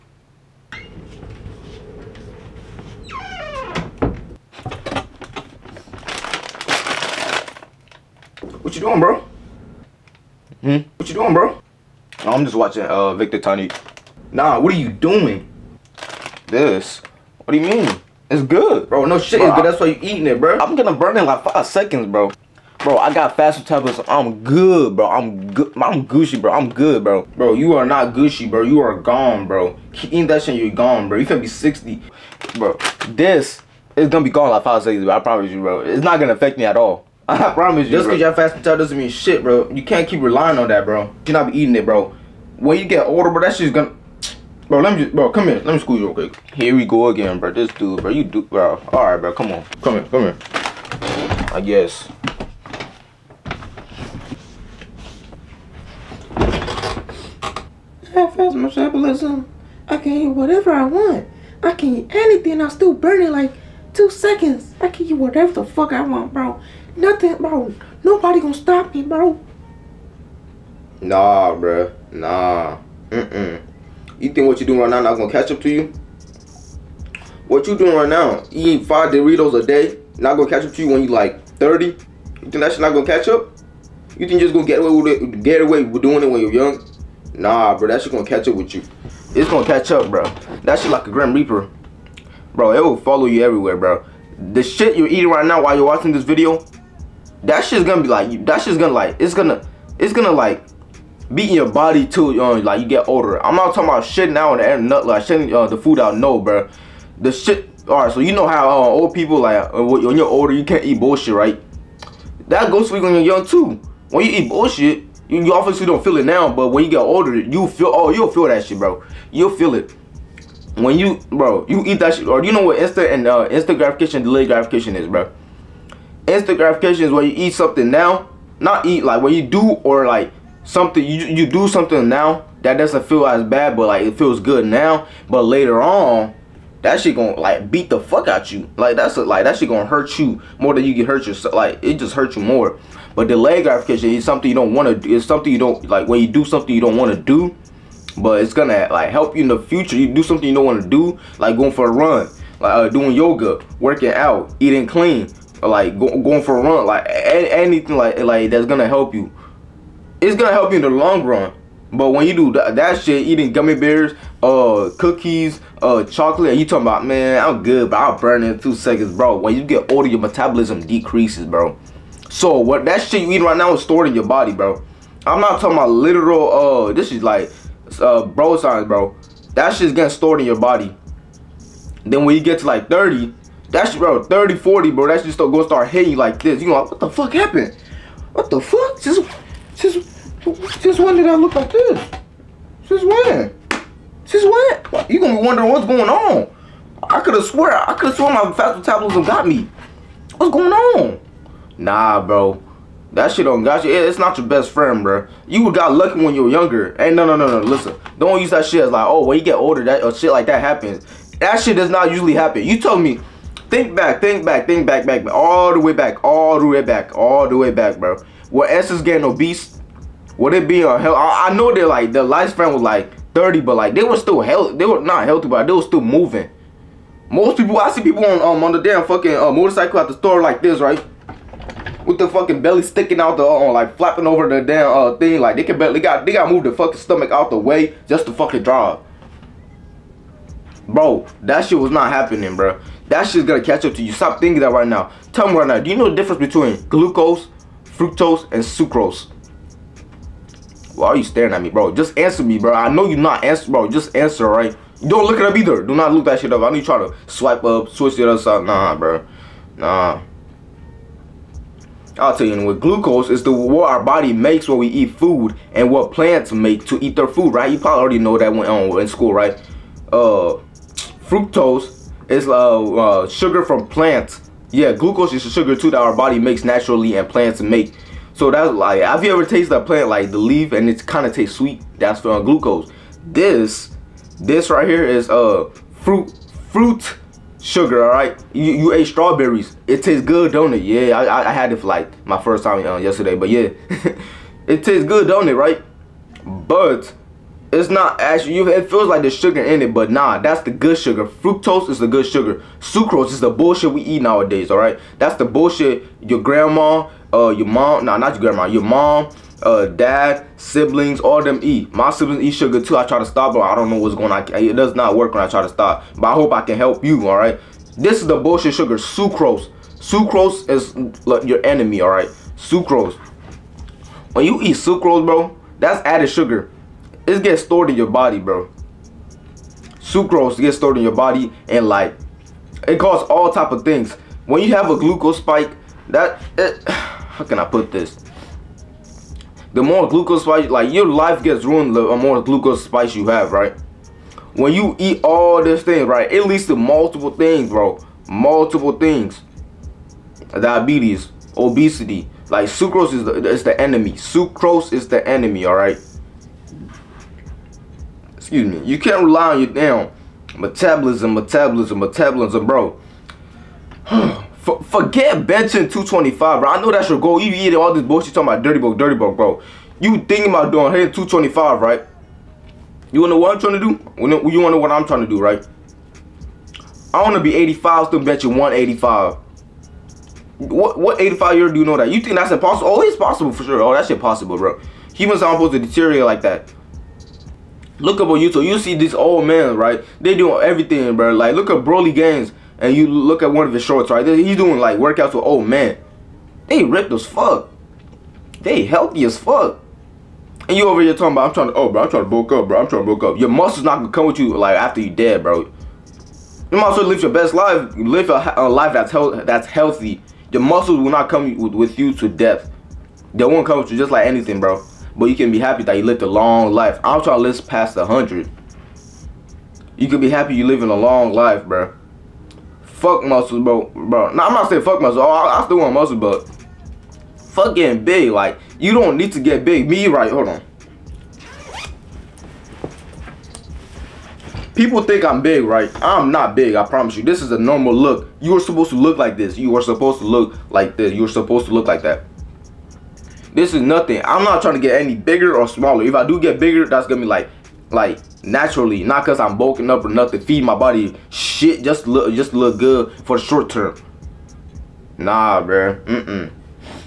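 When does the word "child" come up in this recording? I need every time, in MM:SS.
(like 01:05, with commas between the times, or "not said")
00:38.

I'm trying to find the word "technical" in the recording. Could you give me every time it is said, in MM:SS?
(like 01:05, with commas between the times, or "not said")
not said.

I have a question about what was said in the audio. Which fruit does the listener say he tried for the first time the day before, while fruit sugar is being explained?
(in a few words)
strawberries.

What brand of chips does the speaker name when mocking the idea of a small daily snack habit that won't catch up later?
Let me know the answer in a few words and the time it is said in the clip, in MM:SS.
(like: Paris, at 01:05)
Doritos, at 01:19.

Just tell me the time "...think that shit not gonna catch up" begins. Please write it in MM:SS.
01:22.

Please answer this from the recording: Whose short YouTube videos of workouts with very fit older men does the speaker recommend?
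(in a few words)
Broly Games.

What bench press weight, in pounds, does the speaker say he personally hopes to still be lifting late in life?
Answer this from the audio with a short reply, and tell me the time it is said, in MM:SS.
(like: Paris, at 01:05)
185, at 06:18.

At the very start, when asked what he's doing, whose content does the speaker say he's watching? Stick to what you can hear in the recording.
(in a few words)
Victor Itaniyi.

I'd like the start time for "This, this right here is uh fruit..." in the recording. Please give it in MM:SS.
04:43.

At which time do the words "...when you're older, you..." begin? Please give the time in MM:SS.
01:49.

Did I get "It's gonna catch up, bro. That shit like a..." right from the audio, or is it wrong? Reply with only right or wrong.
right.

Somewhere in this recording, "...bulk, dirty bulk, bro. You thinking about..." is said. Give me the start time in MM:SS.
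06:08.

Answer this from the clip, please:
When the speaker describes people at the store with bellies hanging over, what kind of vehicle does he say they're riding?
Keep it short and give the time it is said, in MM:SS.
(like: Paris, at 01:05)
motorcycle, at 03:49.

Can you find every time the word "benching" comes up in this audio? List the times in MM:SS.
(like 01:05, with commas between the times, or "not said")
06:05, 06:18.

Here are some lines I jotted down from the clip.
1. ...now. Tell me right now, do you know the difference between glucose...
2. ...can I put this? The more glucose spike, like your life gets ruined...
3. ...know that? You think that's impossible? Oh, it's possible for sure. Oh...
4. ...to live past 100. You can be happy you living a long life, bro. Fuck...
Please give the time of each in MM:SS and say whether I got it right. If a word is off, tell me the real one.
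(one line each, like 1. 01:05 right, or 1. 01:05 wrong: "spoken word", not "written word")
1. 04:04 right
2. 05:37 right
3. 06:21 right
4. 06:57 right.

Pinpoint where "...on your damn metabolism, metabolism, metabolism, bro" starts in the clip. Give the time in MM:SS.
05:59.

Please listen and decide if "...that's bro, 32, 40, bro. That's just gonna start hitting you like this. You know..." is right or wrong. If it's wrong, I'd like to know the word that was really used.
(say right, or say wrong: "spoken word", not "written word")
wrong: "30", not "32".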